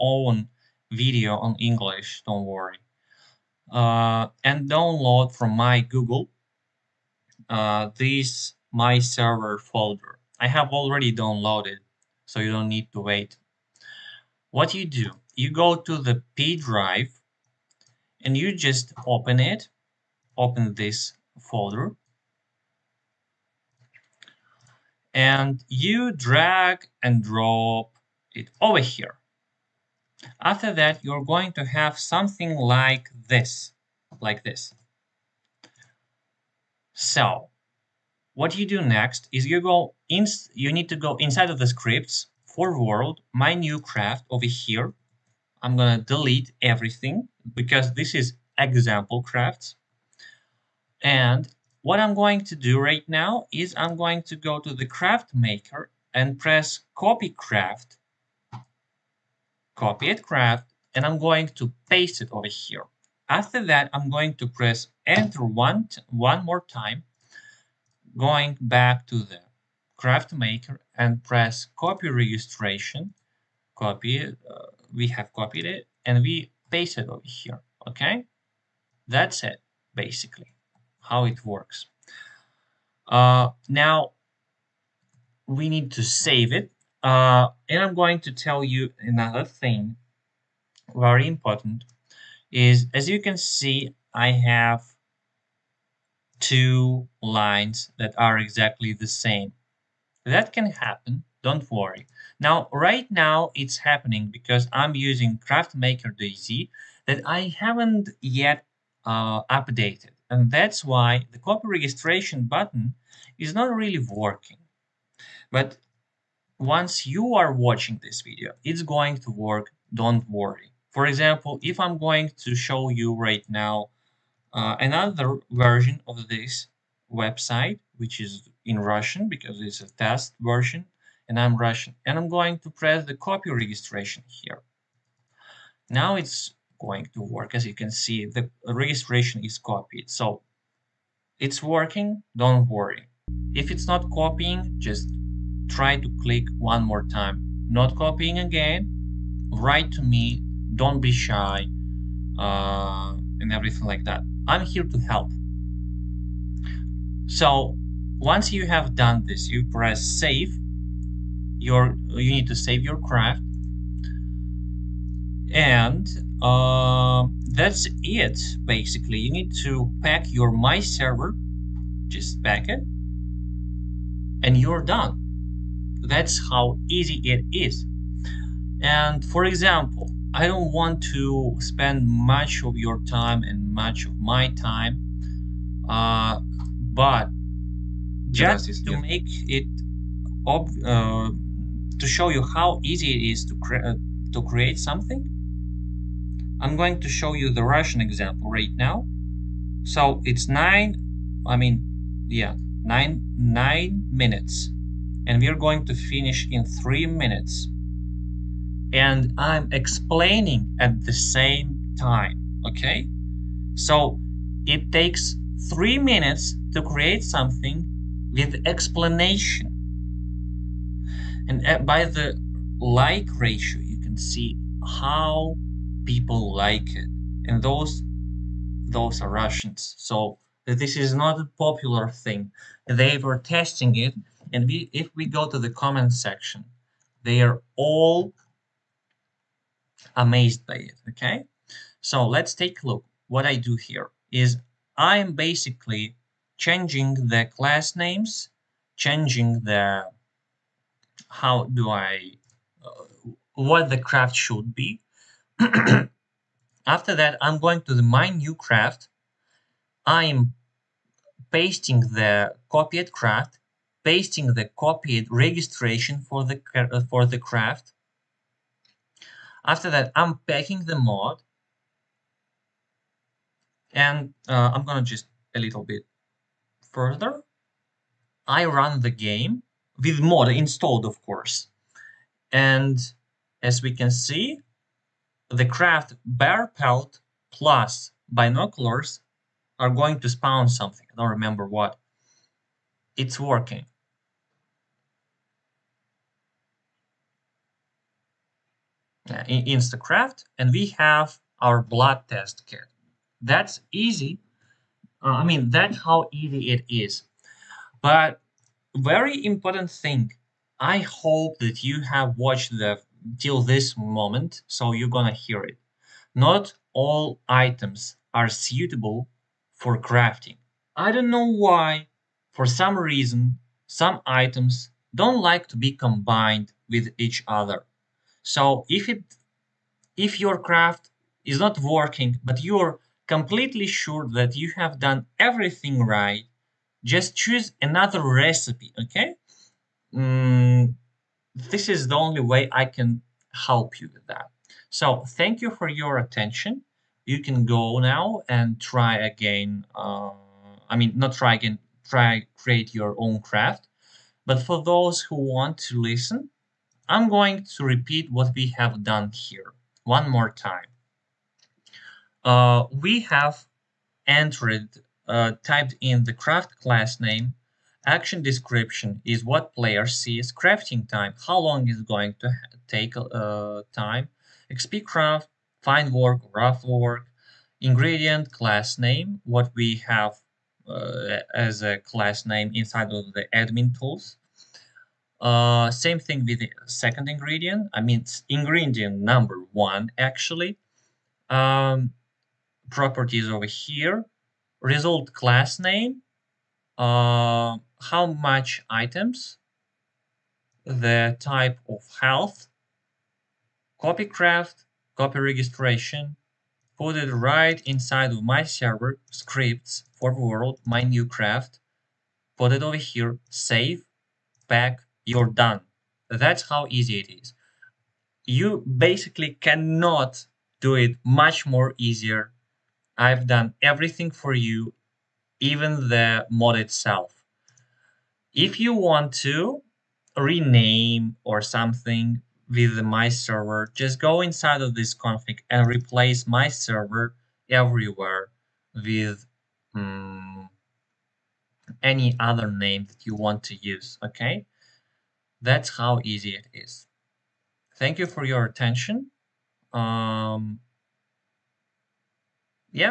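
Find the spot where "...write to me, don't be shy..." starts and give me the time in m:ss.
2:29.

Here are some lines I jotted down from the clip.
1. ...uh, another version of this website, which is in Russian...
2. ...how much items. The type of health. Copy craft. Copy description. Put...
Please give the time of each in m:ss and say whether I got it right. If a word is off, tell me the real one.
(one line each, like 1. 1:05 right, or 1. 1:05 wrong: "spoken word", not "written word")
1. 2:04 right
2. 6:38 wrong: "registration", not "description".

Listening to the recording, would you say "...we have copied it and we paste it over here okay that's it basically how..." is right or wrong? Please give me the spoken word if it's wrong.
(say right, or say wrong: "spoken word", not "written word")
right.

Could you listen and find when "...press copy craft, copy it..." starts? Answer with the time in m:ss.
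0:56.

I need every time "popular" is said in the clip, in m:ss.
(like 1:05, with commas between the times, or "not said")
3:51.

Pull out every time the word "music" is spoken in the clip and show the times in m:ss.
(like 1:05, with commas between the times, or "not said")
not said.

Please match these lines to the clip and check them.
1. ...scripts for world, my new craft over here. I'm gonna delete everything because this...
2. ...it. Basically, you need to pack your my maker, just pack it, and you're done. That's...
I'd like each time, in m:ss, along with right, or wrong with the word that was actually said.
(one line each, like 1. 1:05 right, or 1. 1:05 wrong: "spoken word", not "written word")
1. 0:41 right
2. 2:48 wrong: "server", not "maker".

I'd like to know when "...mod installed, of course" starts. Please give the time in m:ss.
4:40.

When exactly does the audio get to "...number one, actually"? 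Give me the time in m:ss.
6:29.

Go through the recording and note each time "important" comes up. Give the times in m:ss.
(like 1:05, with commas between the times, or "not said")
1:31, 5:09.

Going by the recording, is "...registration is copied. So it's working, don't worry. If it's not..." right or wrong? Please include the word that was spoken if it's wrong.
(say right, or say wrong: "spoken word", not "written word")
right.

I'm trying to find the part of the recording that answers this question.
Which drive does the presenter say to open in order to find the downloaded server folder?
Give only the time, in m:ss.
0:16.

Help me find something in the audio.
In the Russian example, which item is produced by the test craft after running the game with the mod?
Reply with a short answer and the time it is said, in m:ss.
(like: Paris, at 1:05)
Blood test kit, at 5:01.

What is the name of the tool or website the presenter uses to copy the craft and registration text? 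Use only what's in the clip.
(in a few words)
CraftMaker DZ.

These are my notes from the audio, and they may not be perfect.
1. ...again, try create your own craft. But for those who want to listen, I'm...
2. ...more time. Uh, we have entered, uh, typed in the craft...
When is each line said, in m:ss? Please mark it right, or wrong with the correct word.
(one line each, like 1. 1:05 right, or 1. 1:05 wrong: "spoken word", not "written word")
1. 5:51 right
2. 6:00 right.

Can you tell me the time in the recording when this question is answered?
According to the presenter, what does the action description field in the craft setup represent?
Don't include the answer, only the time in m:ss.
6:09.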